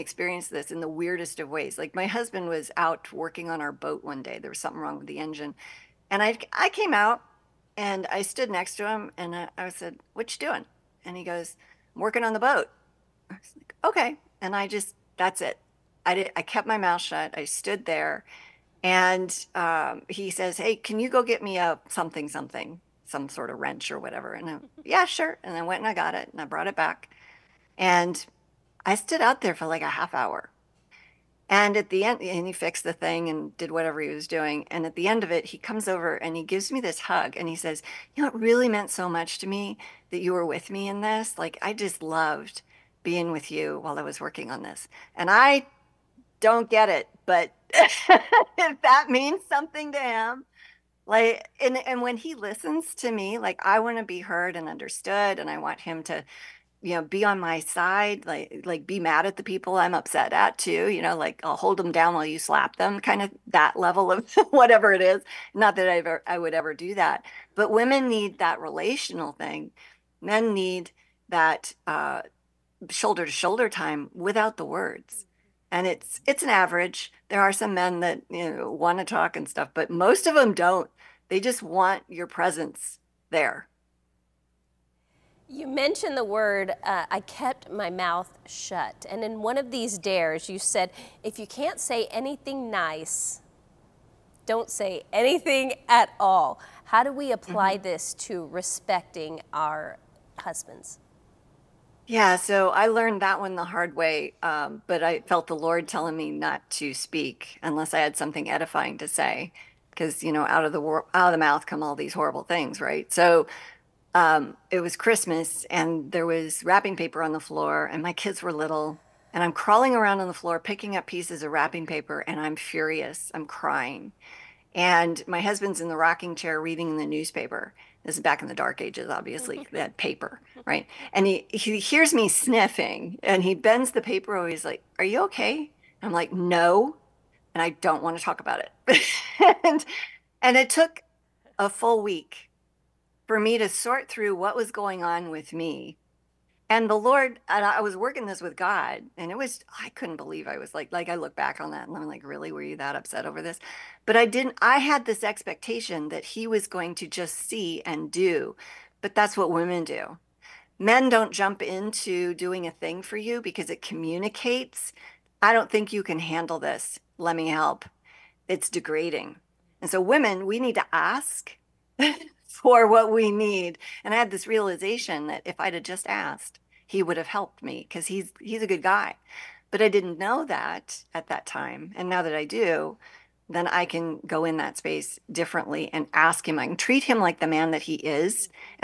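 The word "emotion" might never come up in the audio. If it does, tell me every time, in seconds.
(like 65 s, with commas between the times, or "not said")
not said.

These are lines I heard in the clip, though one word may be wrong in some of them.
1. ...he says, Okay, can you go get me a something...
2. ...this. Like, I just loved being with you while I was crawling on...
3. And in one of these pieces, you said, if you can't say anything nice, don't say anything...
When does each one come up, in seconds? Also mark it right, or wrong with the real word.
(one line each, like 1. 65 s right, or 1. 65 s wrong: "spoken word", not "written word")
1. 20 s wrong: "Hey", not "Okay"
2. 41 s wrong: "working", not "crawling"
3. 89 s wrong: "dares", not "pieces".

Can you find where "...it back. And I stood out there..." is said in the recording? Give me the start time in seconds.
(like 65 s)
26 s.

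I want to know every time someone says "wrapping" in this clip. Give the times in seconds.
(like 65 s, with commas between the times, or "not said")
116 s, 121 s.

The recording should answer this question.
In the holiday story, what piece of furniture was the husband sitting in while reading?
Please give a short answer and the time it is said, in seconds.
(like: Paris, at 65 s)
rocking chair, at 125 s.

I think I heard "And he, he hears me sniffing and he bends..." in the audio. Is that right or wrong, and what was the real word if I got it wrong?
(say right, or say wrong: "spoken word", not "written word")
right.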